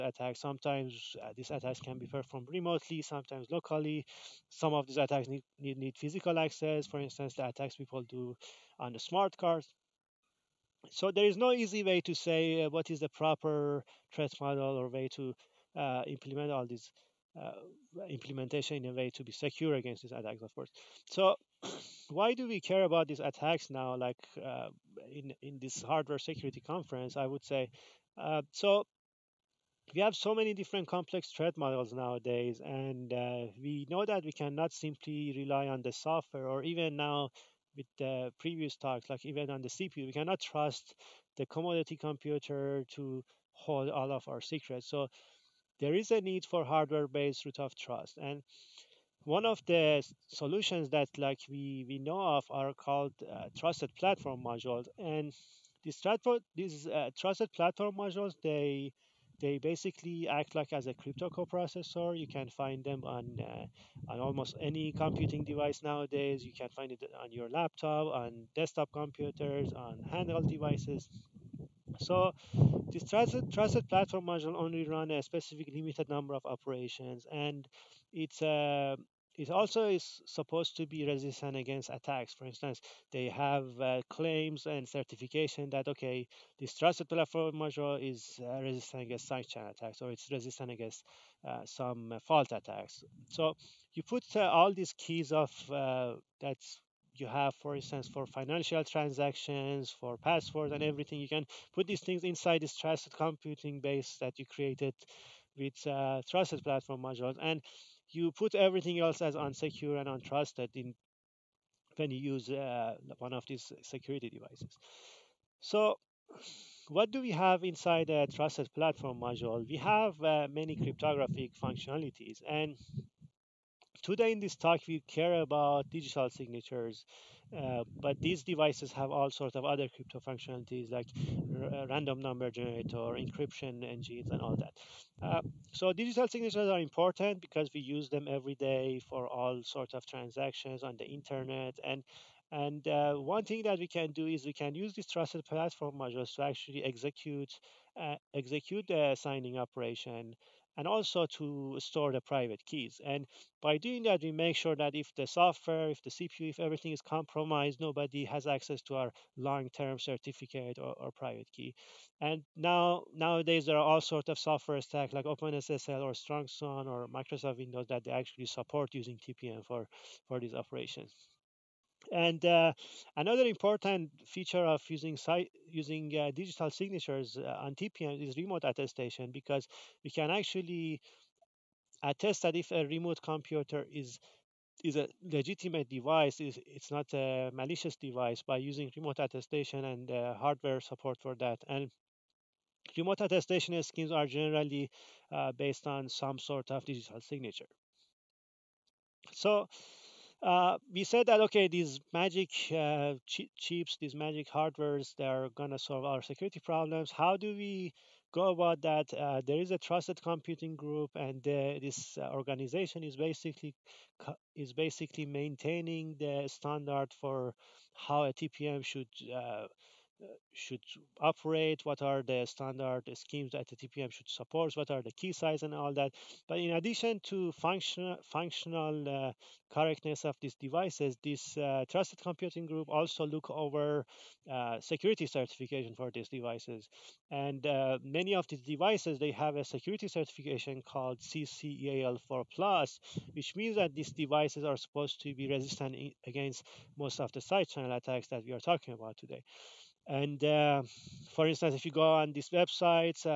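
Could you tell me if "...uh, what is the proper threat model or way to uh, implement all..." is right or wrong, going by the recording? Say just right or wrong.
right.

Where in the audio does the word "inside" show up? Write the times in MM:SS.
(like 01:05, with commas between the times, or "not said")
01:42, 01:57.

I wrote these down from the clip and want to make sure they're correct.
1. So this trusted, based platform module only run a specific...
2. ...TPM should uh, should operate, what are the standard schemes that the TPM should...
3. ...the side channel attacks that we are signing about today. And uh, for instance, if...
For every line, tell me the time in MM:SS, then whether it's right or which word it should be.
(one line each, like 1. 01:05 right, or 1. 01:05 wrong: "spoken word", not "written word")
1. 01:11 wrong: "trusted", not "based"
2. 03:38 right
3. 04:07 wrong: "talking", not "signing".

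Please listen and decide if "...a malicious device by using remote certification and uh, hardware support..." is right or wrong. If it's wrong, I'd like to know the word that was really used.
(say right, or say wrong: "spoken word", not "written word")
wrong: "attestation", not "certification".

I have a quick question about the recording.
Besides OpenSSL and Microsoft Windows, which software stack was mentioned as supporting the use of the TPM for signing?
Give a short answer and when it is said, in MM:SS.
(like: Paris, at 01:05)
StrongSwan, at 02:46.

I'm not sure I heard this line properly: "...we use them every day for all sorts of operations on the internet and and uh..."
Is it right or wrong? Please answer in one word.
wrong.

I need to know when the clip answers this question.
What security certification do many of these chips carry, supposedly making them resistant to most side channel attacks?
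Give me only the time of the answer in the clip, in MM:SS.
04:01.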